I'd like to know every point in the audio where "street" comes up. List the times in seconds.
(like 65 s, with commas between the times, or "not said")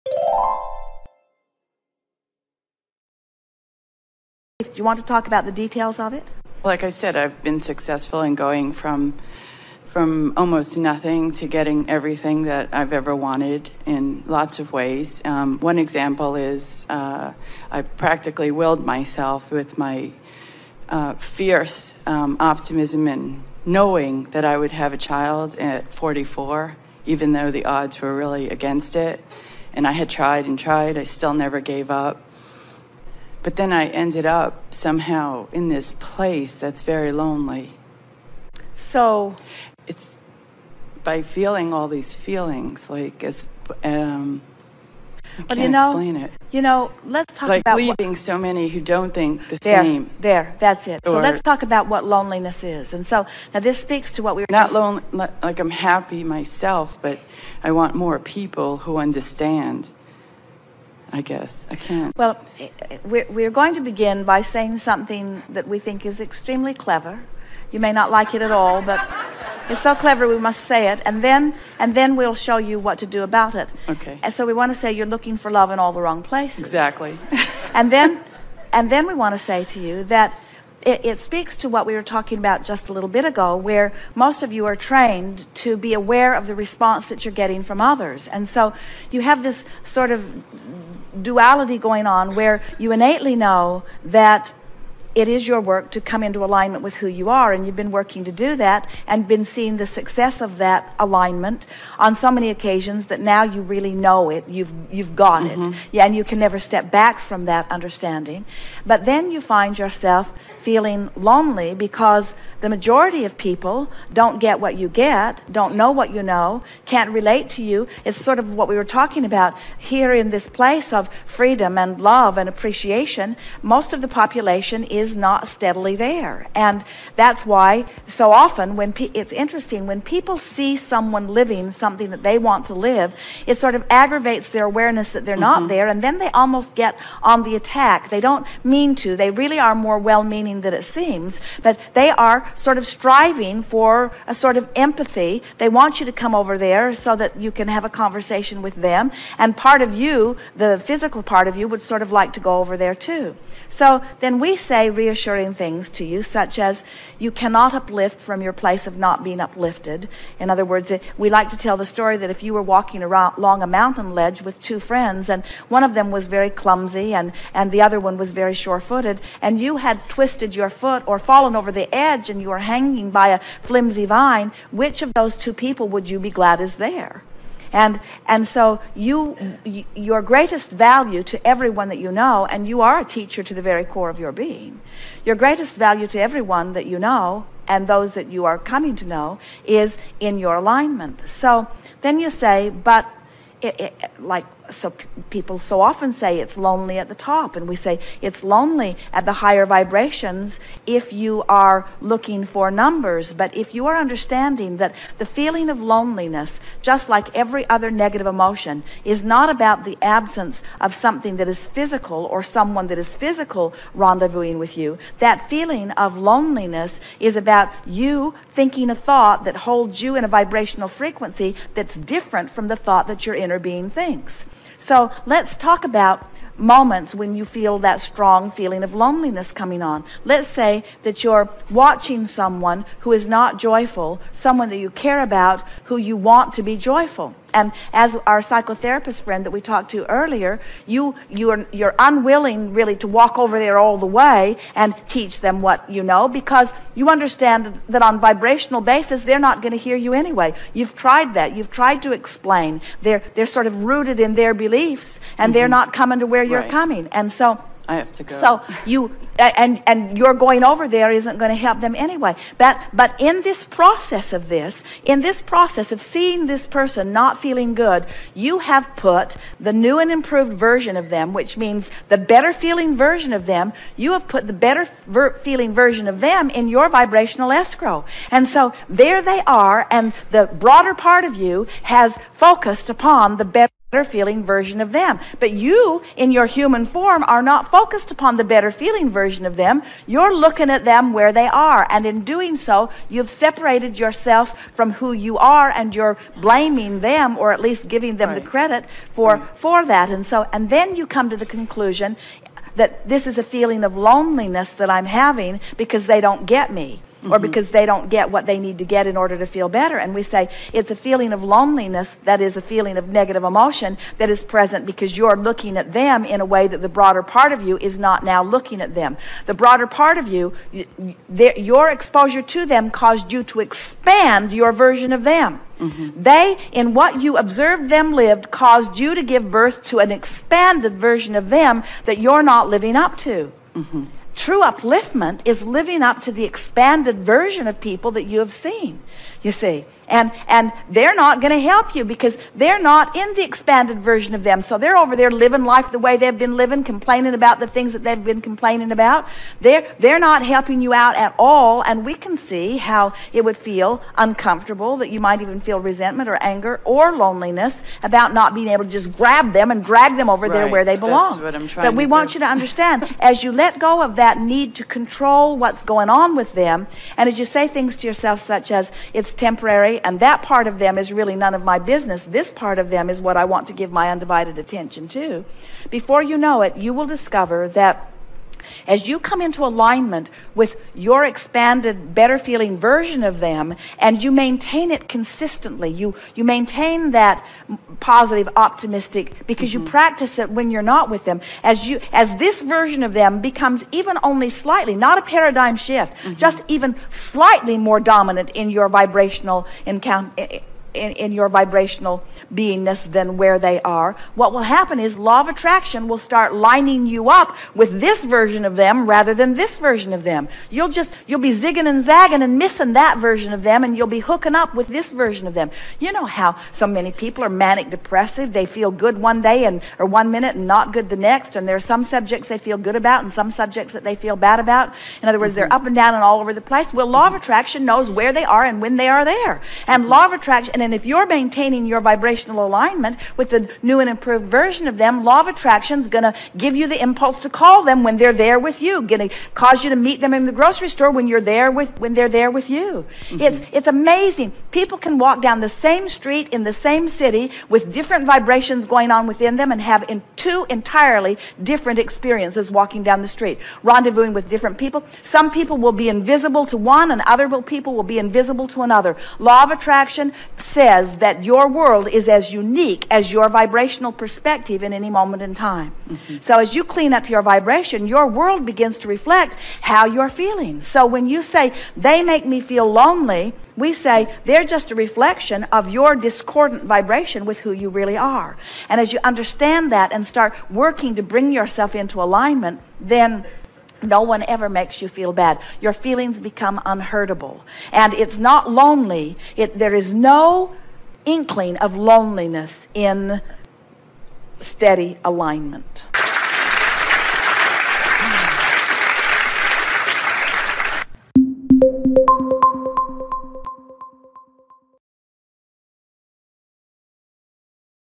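446 s, 453 s.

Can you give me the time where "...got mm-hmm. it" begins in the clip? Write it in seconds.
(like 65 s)
105 s.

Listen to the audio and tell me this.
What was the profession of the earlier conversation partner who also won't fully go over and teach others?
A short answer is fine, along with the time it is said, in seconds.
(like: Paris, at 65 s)
psychotherapist, at 238 s.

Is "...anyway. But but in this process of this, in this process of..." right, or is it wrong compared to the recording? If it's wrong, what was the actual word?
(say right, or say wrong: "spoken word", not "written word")
right.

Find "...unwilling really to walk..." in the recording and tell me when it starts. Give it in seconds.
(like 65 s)
241 s.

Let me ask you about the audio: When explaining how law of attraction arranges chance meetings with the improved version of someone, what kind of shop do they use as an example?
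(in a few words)
grocery store.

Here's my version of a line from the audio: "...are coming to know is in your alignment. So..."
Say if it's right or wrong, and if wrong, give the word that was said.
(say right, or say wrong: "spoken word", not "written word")
right.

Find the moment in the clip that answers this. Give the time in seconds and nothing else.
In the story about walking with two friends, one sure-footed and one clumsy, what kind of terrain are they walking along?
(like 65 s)
163 s.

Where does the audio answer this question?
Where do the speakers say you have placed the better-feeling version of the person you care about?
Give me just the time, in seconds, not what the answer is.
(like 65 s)
276 s.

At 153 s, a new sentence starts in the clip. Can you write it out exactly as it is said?
So then we say reassuring things to you, such as you cannot uplift from your place of not being uplifted.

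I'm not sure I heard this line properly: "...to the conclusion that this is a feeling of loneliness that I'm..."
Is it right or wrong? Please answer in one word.
right.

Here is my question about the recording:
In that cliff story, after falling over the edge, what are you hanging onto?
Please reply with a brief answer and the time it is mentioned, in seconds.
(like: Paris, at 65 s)
a flimsy vine, at 173 s.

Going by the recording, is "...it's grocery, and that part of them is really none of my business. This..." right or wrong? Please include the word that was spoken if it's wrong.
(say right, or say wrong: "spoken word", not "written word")
wrong: "temporary", not "grocery".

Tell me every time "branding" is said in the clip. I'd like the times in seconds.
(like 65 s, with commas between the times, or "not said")
not said.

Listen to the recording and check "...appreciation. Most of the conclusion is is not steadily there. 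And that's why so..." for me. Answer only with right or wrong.
wrong.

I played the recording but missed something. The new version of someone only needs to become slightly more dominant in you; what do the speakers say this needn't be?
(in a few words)
a paradigm shift.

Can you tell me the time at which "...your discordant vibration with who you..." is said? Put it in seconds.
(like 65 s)
475 s.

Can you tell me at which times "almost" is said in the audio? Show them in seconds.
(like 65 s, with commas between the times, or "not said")
10 s, 136 s.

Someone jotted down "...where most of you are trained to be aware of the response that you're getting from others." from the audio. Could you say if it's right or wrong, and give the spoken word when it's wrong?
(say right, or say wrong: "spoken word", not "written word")
right.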